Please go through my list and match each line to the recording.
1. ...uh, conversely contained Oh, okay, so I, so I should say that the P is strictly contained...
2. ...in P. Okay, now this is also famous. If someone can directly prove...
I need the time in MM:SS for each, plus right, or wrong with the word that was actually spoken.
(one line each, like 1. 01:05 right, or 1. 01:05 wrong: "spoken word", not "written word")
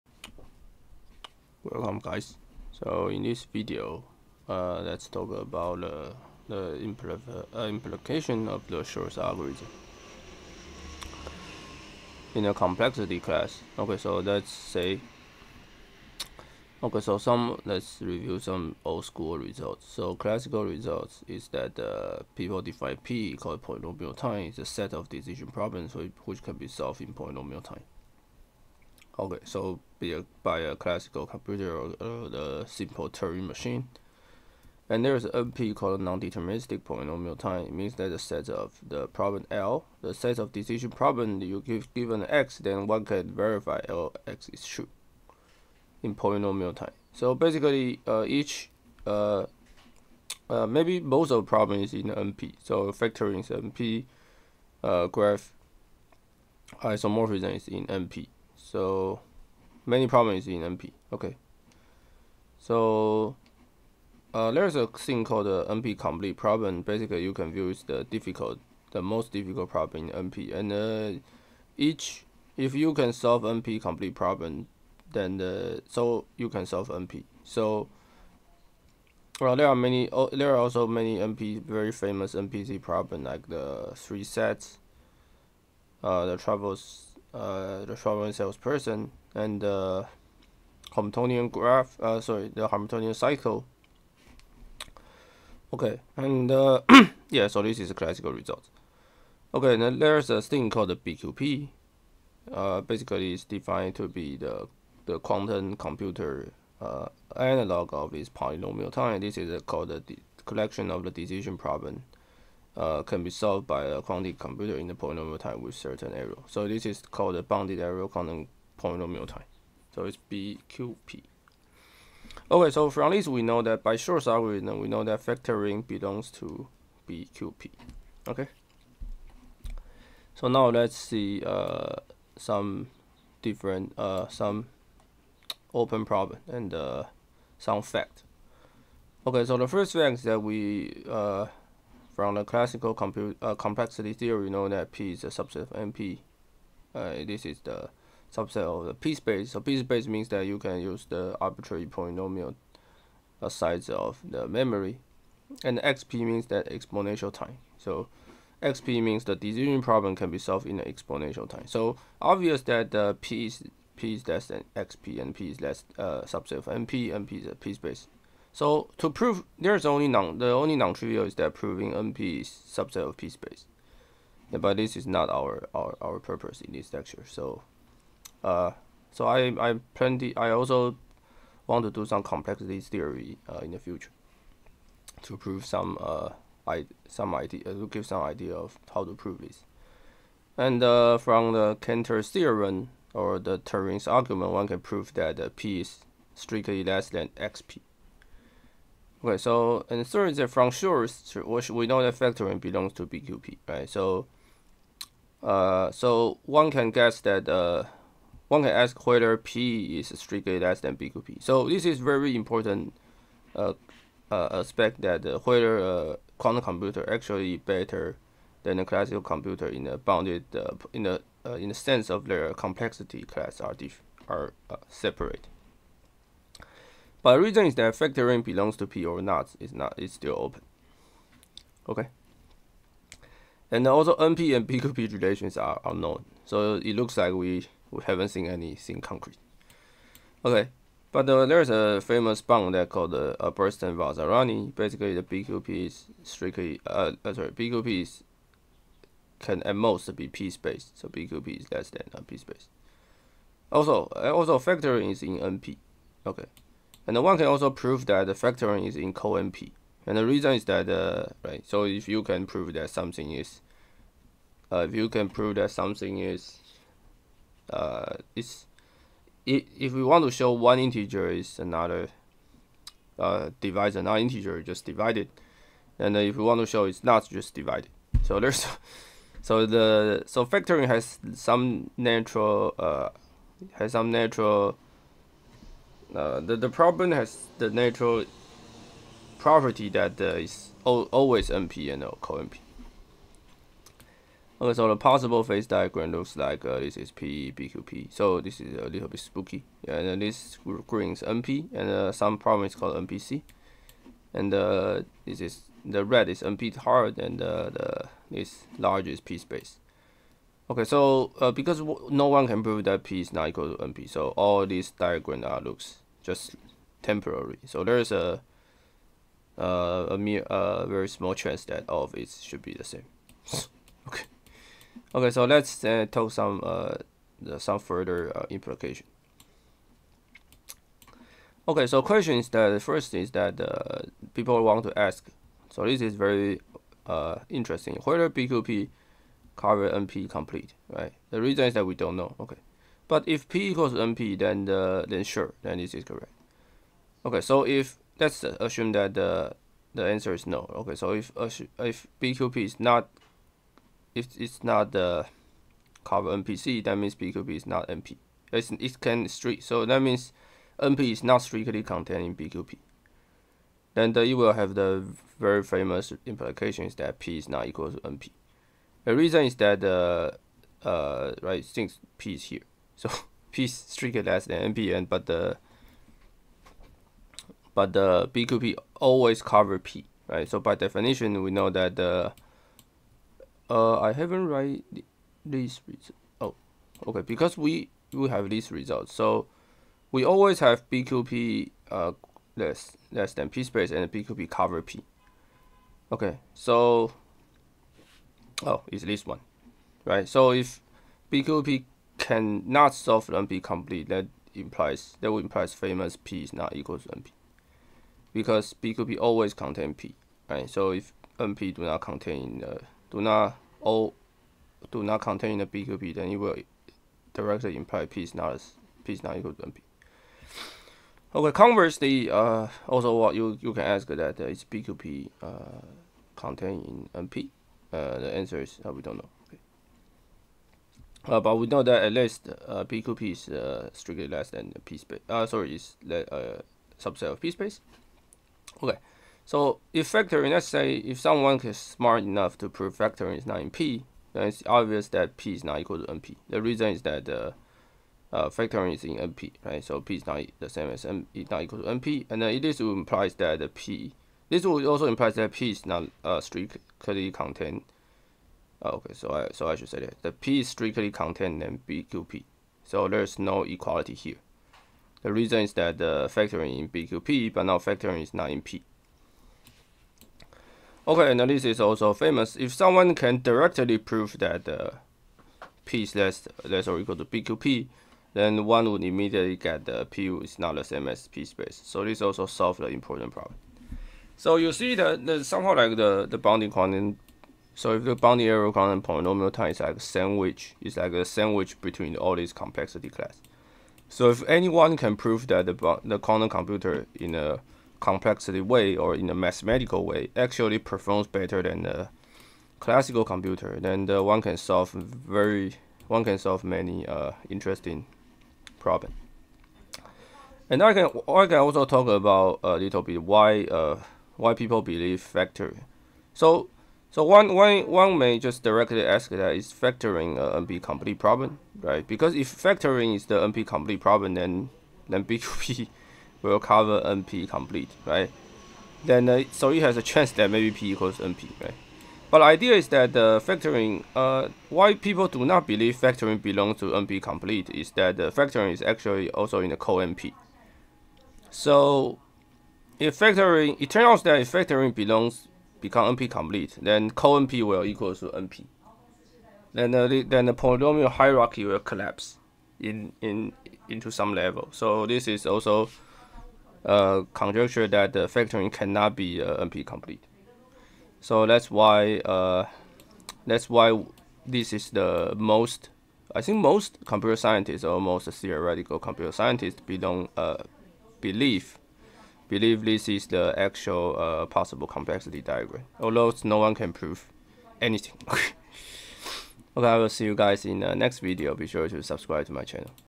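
1. 07:36 wrong: "strictly", not "conversely"
2. 07:48 right.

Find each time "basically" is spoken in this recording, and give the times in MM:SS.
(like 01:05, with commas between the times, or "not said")
00:47, 01:06, 01:42, 04:04.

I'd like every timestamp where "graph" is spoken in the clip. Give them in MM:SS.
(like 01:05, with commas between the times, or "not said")
00:55, 01:31.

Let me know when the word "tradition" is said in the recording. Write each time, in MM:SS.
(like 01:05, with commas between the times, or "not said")
not said.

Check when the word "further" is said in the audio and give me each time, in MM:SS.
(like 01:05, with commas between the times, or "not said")
05:27.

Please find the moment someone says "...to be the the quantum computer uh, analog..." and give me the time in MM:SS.
01:43.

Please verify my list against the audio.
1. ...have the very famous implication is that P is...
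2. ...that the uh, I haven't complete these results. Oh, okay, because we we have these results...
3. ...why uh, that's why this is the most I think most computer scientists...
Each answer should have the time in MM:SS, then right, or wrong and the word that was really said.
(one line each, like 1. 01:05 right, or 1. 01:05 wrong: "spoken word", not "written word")
1. 06:04 right
2. 06:21 wrong: "write", not "complete"
3. 09:21 right.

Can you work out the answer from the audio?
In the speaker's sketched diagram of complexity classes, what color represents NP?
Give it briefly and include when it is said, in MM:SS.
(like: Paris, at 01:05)
Green, at 05:00.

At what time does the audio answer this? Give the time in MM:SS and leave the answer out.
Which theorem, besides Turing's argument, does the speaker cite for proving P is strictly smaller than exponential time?
03:11.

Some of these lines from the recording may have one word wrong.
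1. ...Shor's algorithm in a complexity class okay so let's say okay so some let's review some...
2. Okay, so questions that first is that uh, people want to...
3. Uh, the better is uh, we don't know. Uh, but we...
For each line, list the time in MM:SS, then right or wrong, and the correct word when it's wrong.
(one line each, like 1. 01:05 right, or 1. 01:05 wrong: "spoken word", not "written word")
1. 00:08 right
2. 05:31 right
3. 07:07 wrong: "answer", not "better".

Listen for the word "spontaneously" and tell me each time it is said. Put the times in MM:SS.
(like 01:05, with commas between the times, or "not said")
not said.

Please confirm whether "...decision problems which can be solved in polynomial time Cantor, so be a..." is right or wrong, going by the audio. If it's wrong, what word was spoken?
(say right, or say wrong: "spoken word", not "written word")
wrong: "Okay", not "Cantor".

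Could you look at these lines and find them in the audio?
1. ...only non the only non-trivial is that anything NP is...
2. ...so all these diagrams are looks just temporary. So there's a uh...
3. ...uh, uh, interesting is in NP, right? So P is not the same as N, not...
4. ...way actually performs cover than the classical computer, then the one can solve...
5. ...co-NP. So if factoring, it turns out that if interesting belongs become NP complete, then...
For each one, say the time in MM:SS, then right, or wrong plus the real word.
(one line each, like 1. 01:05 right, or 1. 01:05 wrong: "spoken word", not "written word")
1. 02:49 wrong: "proving", not "anything"
2. 05:14 right
3. 07:27 wrong: "factoring", not "interesting"
4. 08:20 wrong: "better", not "cover"
5. 08:59 wrong: "factoring", not "interesting".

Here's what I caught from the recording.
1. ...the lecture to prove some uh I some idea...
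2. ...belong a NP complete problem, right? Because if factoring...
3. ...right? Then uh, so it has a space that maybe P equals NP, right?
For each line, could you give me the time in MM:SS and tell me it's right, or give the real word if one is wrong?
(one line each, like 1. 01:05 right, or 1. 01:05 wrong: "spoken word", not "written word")
1. 03:03 wrong: "future", not "lecture"
2. 08:39 wrong: "factoring", not "belong"
3. 08:48 wrong: "chance", not "space".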